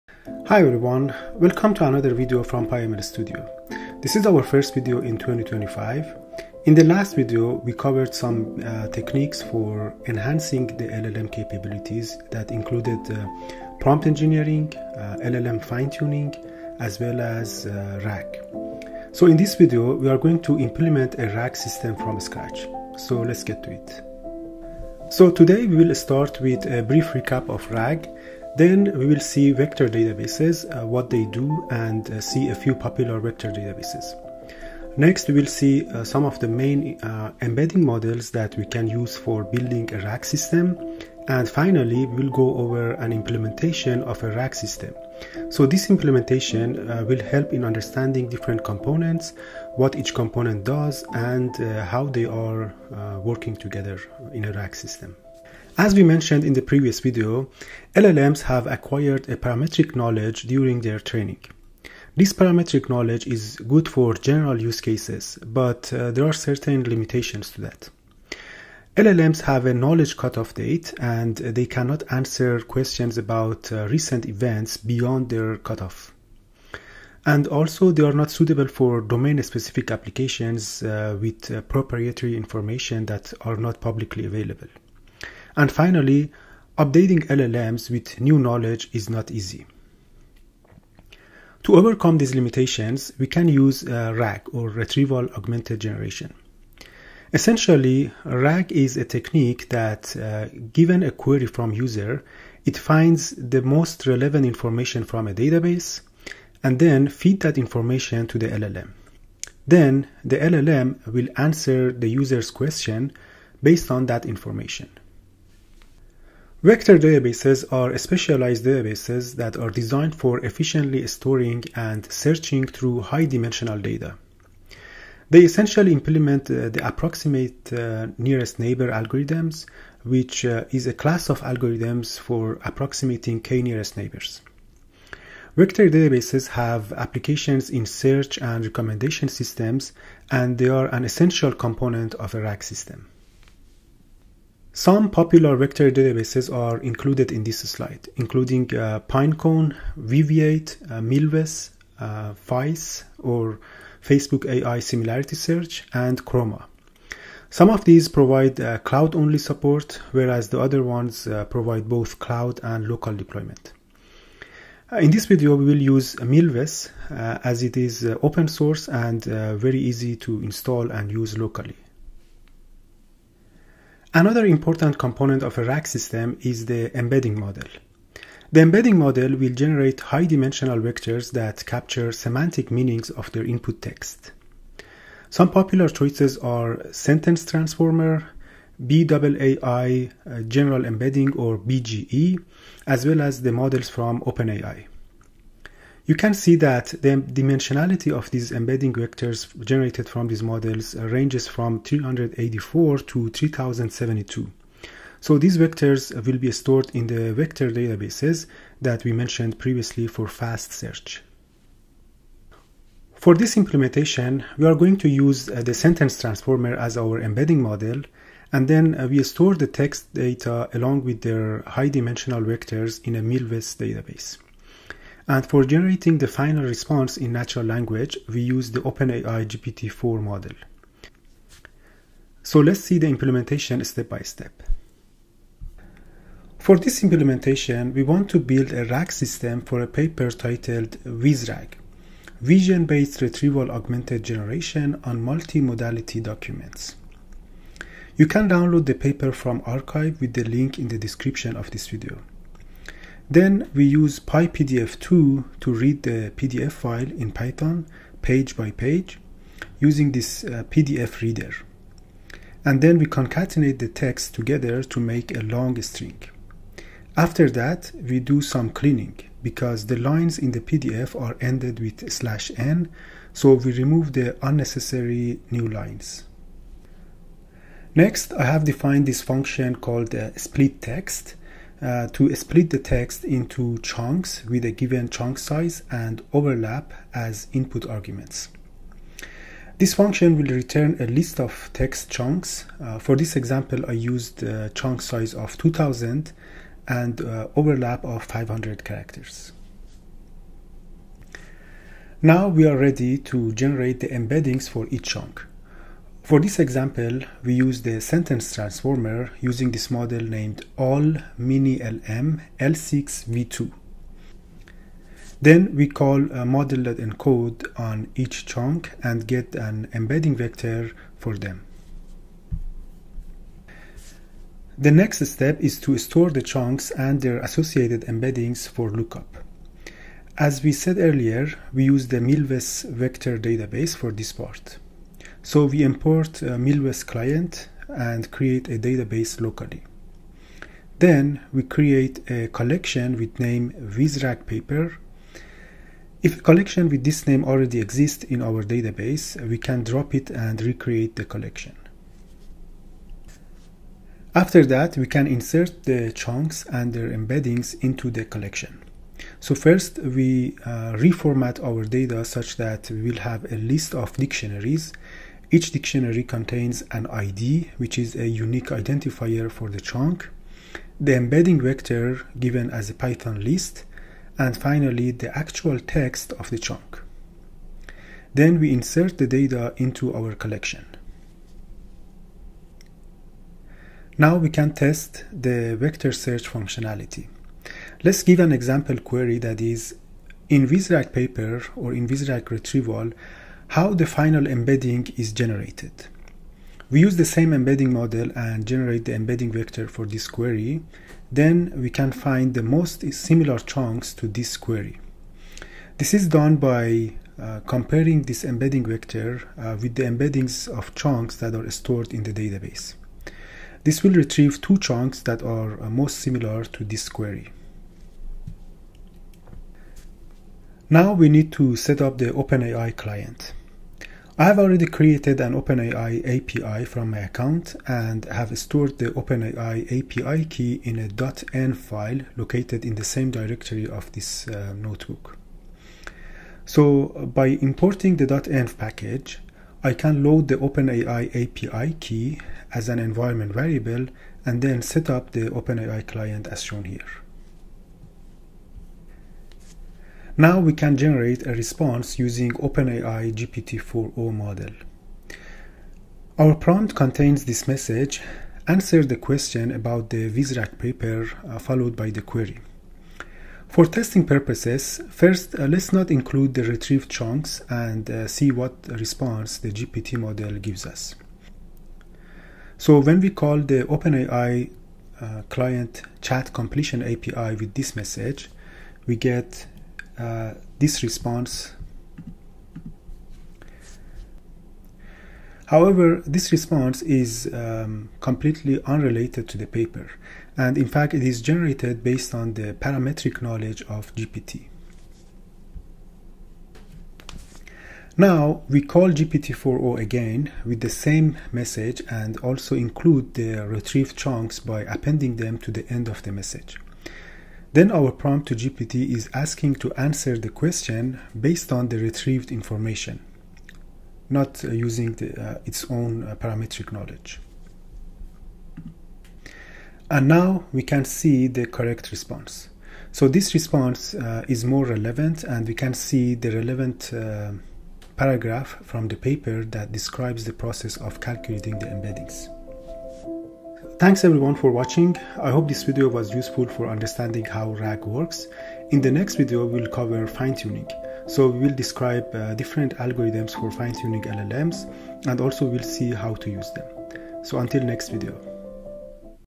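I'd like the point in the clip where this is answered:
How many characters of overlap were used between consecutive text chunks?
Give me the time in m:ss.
4:58.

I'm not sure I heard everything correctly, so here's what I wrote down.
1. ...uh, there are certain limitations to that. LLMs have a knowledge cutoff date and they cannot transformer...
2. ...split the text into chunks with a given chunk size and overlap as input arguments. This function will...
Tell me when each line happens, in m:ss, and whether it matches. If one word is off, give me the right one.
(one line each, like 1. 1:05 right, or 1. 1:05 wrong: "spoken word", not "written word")
1. 1:05 wrong: "answer", not "transformer"
2. 4:42 right.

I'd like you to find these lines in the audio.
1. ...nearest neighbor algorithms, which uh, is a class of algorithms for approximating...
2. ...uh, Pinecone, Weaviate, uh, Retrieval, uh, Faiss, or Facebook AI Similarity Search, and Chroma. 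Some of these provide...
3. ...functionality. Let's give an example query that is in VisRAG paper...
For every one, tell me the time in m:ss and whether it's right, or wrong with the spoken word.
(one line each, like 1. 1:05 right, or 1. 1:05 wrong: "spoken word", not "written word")
1. 2:08 right
2. 2:28 wrong: "Milvus", not "Retrieval"
3. 6:26 right.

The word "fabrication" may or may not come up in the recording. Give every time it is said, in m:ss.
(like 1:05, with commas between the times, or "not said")
not said.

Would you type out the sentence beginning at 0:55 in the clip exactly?
As we mentioned in the previous video, LLMs have acquired a parametric knowledge during their training.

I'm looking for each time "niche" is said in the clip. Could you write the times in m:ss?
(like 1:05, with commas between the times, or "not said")
not said.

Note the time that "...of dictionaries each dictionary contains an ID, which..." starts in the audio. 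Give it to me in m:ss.
6:03.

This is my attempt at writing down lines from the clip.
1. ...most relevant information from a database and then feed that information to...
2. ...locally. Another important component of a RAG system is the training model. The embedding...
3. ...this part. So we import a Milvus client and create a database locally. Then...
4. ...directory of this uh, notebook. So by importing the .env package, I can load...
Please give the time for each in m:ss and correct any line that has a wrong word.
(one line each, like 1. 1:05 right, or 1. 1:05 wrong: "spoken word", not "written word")
1. 1:43 right
2. 2:51 wrong: "embedding", not "training"
3. 5:34 right
4. 7:13 right.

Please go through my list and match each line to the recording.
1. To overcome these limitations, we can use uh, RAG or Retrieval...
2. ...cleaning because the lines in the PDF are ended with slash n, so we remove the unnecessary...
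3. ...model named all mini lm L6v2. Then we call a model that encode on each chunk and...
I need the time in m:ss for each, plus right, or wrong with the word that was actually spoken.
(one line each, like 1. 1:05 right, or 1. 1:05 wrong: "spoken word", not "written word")
1. 1:31 right
2. 4:28 right
3. 5:09 right.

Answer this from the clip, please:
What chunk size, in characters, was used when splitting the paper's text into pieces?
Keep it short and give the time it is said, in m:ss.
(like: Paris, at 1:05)
2000, at 4:55.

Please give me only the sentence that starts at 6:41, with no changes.
Then we can find the most similar chunks to this query.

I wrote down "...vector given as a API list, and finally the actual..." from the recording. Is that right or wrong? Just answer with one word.
wrong.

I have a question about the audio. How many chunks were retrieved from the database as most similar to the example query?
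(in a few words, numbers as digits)
2.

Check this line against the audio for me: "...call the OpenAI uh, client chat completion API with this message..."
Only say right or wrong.
right.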